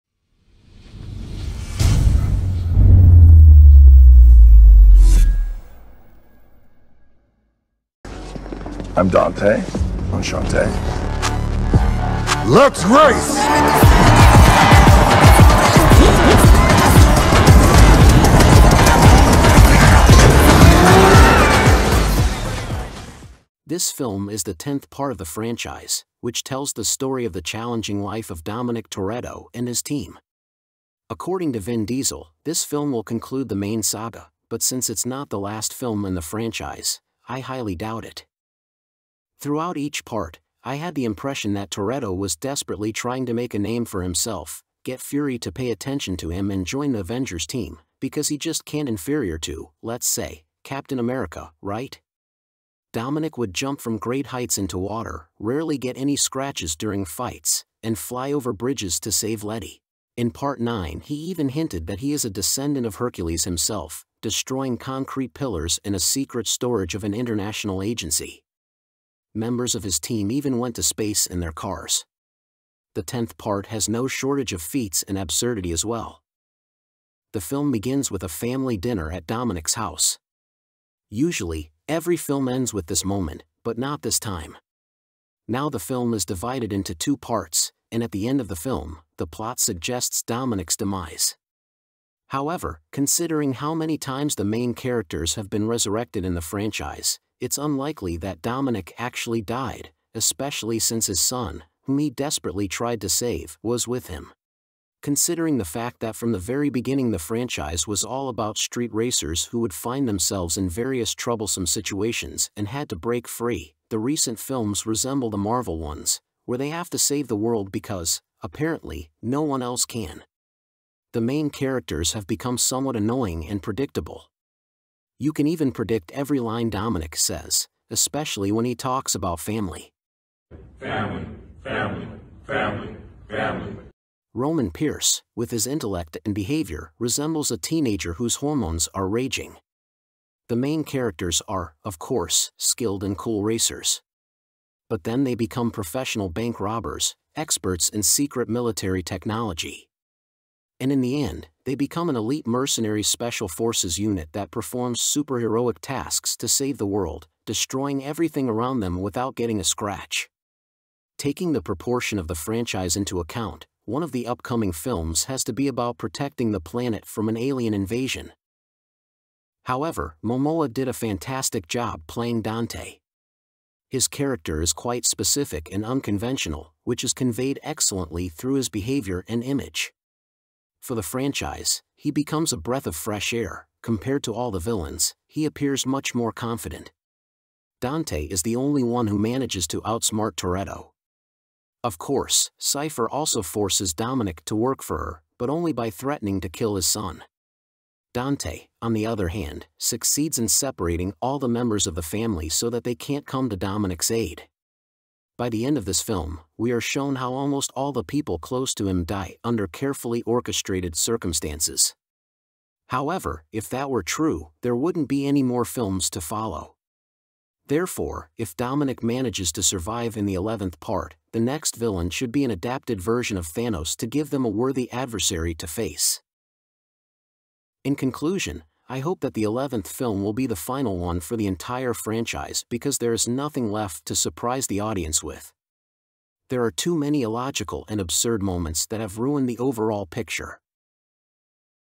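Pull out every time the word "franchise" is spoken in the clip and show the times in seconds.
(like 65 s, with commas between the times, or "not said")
25 s, 36 s, 96 s, 107 s, 162 s, 181 s, 231 s.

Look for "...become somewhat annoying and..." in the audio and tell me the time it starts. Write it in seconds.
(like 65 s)
122 s.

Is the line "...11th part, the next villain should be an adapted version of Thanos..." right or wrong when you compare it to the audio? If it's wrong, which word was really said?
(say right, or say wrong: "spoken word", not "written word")
right.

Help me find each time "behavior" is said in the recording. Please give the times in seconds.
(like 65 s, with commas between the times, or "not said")
136 s, 178 s.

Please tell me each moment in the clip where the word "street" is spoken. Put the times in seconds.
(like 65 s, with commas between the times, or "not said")
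108 s.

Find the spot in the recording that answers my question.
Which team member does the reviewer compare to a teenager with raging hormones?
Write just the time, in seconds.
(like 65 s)
134 s.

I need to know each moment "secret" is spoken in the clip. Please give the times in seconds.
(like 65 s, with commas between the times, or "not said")
65 s, 148 s.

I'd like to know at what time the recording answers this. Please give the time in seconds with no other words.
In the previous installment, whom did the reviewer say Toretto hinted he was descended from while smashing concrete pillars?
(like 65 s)
62 s.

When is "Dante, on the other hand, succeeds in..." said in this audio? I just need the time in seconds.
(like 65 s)
198 s.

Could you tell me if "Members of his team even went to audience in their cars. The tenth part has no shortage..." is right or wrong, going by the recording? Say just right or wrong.
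wrong.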